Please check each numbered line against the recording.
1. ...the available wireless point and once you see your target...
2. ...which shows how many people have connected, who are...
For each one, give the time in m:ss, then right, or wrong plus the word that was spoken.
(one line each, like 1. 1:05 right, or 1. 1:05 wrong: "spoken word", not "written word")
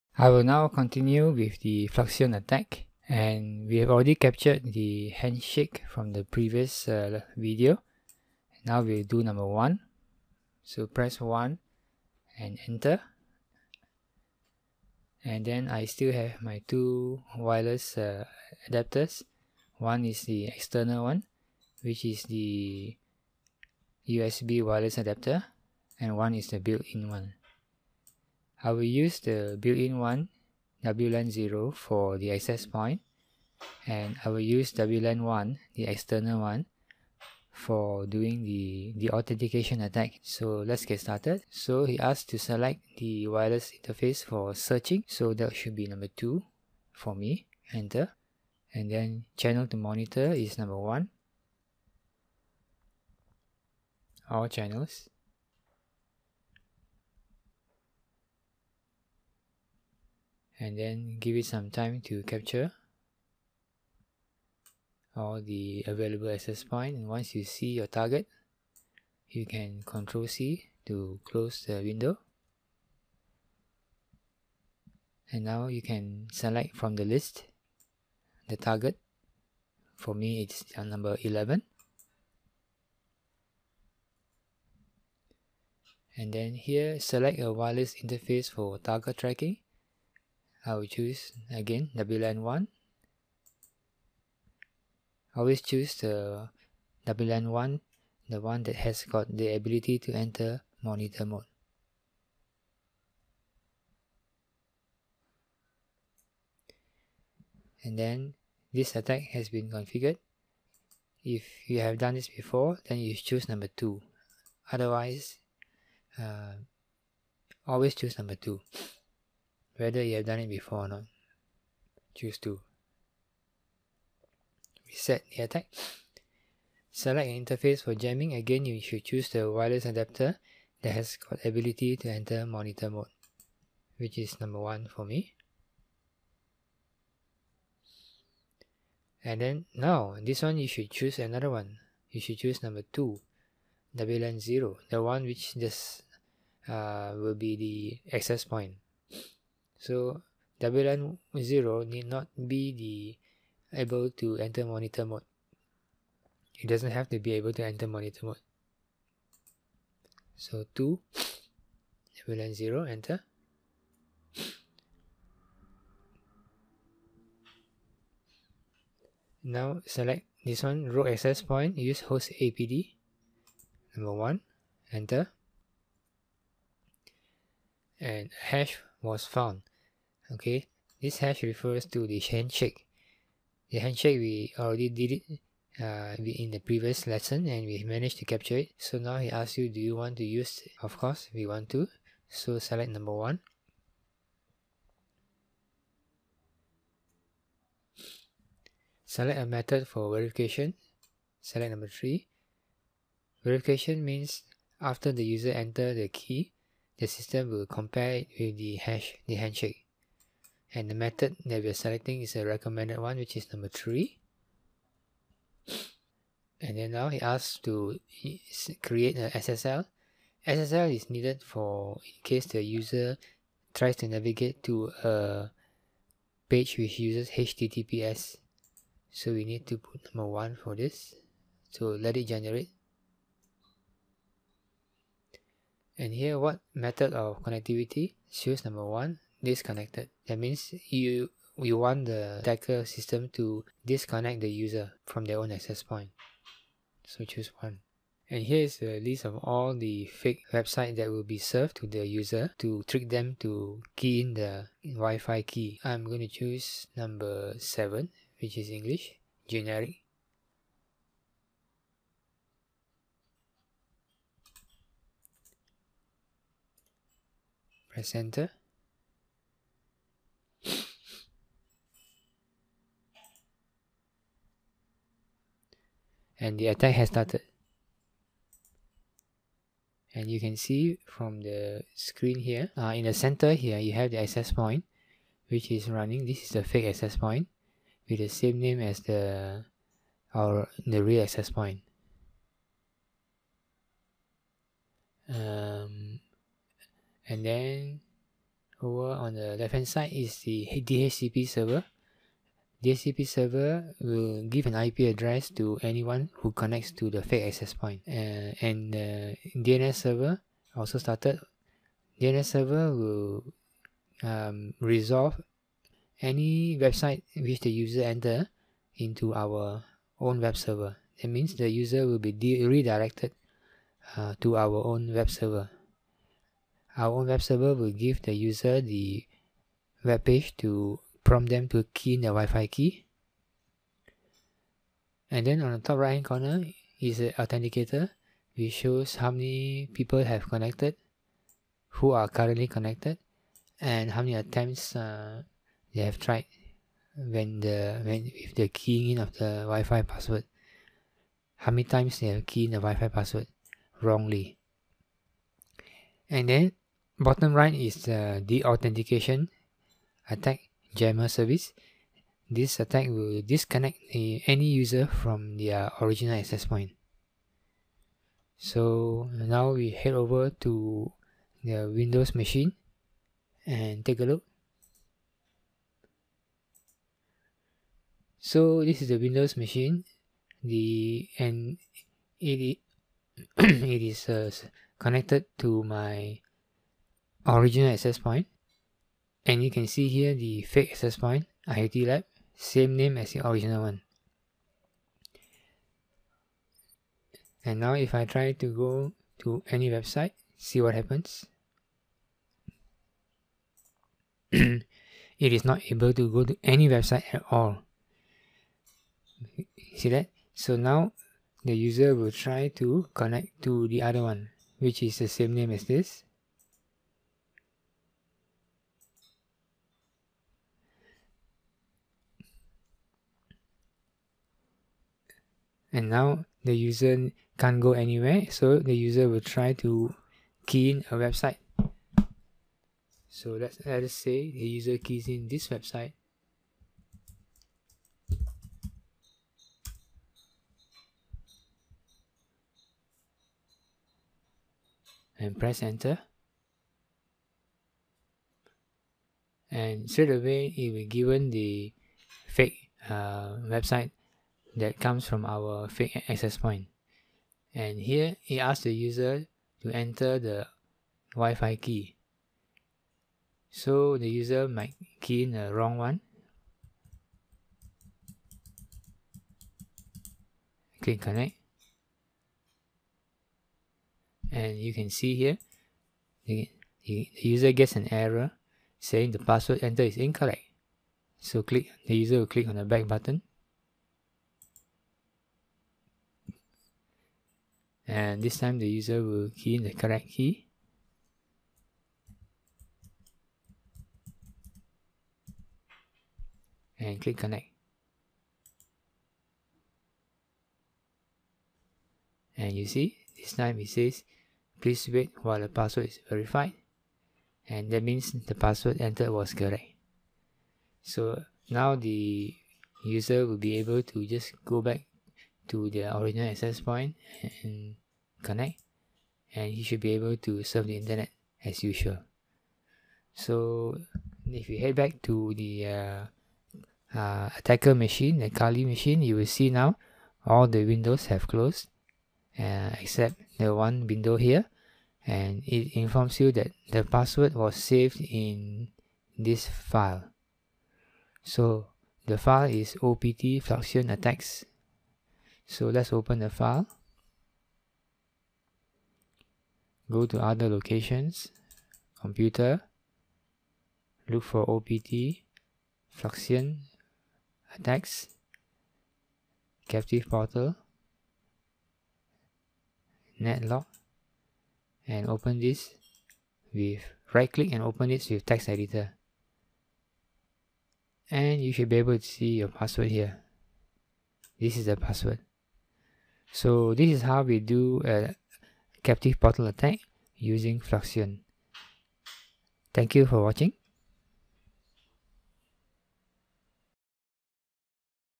1. 1:05 wrong: "access", not "wireless"
2. 5:38 right.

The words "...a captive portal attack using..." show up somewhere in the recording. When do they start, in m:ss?
9:38.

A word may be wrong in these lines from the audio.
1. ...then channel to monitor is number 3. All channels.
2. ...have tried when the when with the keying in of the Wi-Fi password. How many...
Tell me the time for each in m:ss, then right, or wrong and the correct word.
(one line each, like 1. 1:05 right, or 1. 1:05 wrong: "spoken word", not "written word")
1. 0:48 wrong: "1", not "3"
2. 5:46 right.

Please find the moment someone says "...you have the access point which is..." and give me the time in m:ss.
4:43.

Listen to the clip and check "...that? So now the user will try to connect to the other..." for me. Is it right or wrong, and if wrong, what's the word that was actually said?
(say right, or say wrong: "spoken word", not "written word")
right.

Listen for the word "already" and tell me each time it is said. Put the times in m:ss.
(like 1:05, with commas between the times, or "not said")
0:03, 3:04.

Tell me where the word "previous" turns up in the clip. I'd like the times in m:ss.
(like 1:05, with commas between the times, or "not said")
0:06, 3:06.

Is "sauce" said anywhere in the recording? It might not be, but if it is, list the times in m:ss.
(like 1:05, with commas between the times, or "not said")
not said.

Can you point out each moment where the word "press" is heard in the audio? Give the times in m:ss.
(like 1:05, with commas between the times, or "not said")
0:10, 4:27, 7:25.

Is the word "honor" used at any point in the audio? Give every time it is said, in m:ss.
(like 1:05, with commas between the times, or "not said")
not said.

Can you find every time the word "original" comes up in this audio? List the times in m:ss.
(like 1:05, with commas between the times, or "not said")
6:06, 6:27, 6:33, 8:36.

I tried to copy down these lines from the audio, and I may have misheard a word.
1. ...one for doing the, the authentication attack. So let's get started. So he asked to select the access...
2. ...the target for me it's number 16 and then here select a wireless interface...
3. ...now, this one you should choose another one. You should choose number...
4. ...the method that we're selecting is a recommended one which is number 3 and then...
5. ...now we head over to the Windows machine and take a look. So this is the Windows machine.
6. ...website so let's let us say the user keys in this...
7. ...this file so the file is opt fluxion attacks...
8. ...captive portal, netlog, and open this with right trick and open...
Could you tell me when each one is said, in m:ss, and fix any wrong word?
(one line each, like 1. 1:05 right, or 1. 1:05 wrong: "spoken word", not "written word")
1. 0:36 wrong: "wireless", not "access"
2. 1:18 wrong: "11", not "16"
3. 2:19 right
4. 3:30 right
5. 6:09 right
6. 7:11 right
7. 8:59 right
8. 9:19 wrong: "click", not "trick".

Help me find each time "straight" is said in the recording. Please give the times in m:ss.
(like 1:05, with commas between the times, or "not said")
7:30.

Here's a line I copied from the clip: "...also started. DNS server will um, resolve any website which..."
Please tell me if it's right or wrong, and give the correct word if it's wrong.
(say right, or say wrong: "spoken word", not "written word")
right.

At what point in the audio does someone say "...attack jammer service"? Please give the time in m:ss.
6:00.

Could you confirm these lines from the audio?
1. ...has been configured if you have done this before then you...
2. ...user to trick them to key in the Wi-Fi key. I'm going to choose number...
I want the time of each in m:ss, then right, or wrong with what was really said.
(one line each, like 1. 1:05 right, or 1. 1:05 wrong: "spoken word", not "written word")
1. 1:49 right
2. 4:12 right.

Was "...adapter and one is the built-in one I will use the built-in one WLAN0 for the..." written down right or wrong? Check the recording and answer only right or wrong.
right.